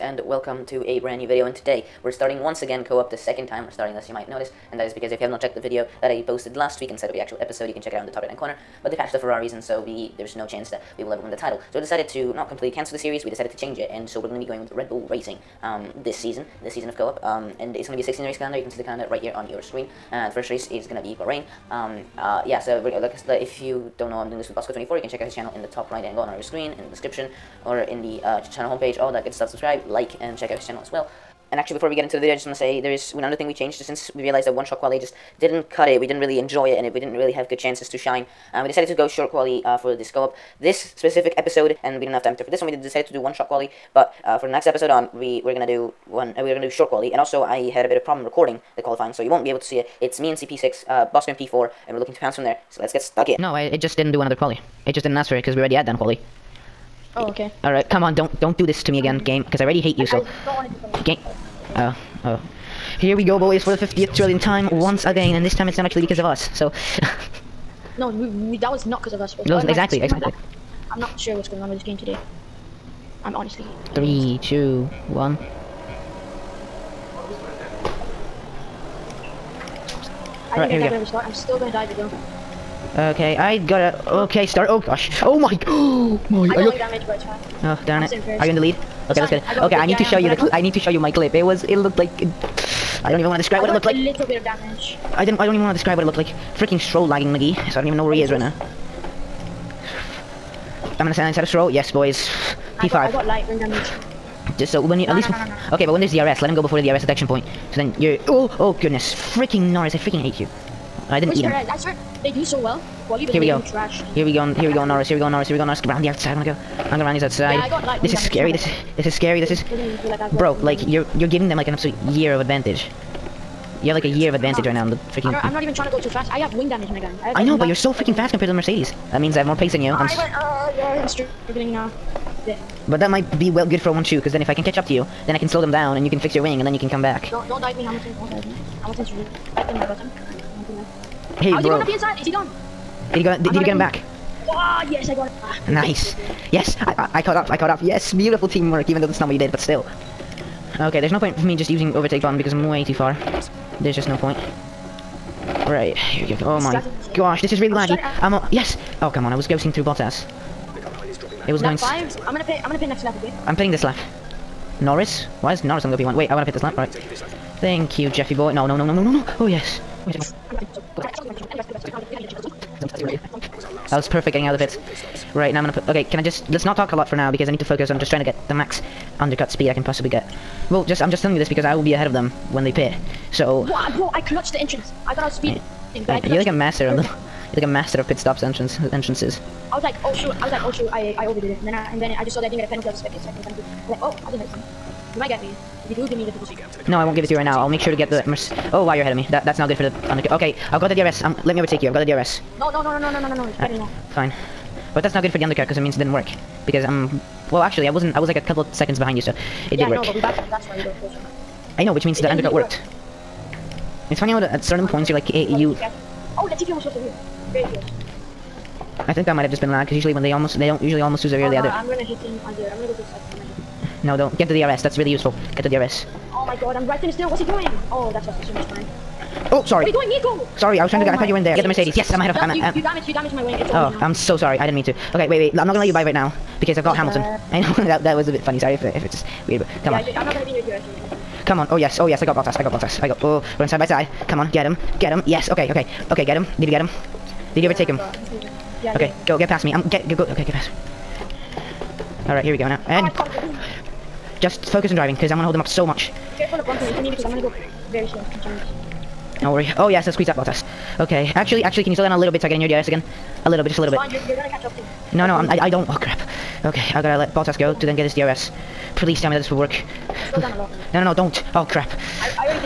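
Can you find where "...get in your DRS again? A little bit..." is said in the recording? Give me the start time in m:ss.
4:22.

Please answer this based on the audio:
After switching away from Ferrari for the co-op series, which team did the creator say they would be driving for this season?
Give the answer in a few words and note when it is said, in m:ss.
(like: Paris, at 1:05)
Red Bull Racing, at 0:14.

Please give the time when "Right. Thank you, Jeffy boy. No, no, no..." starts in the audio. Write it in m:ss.
2:46.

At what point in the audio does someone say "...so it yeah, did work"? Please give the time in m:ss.
3:29.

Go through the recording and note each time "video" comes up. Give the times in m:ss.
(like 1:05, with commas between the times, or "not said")
0:01, 0:05, 0:32.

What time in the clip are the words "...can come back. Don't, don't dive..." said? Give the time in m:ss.
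2:16.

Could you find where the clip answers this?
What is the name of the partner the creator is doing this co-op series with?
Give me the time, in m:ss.
0:24.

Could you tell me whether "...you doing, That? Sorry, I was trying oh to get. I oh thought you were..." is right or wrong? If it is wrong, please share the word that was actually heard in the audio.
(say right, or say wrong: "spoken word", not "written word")
wrong: "Nico", not "That".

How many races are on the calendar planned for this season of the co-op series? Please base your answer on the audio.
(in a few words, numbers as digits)
16.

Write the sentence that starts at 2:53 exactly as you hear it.
That was perfect getting out of the Right, now I'm gonna put...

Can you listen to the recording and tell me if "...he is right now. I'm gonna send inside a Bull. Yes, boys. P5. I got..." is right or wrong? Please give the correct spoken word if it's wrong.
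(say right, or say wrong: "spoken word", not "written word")
wrong: "Stroll", not "Bull".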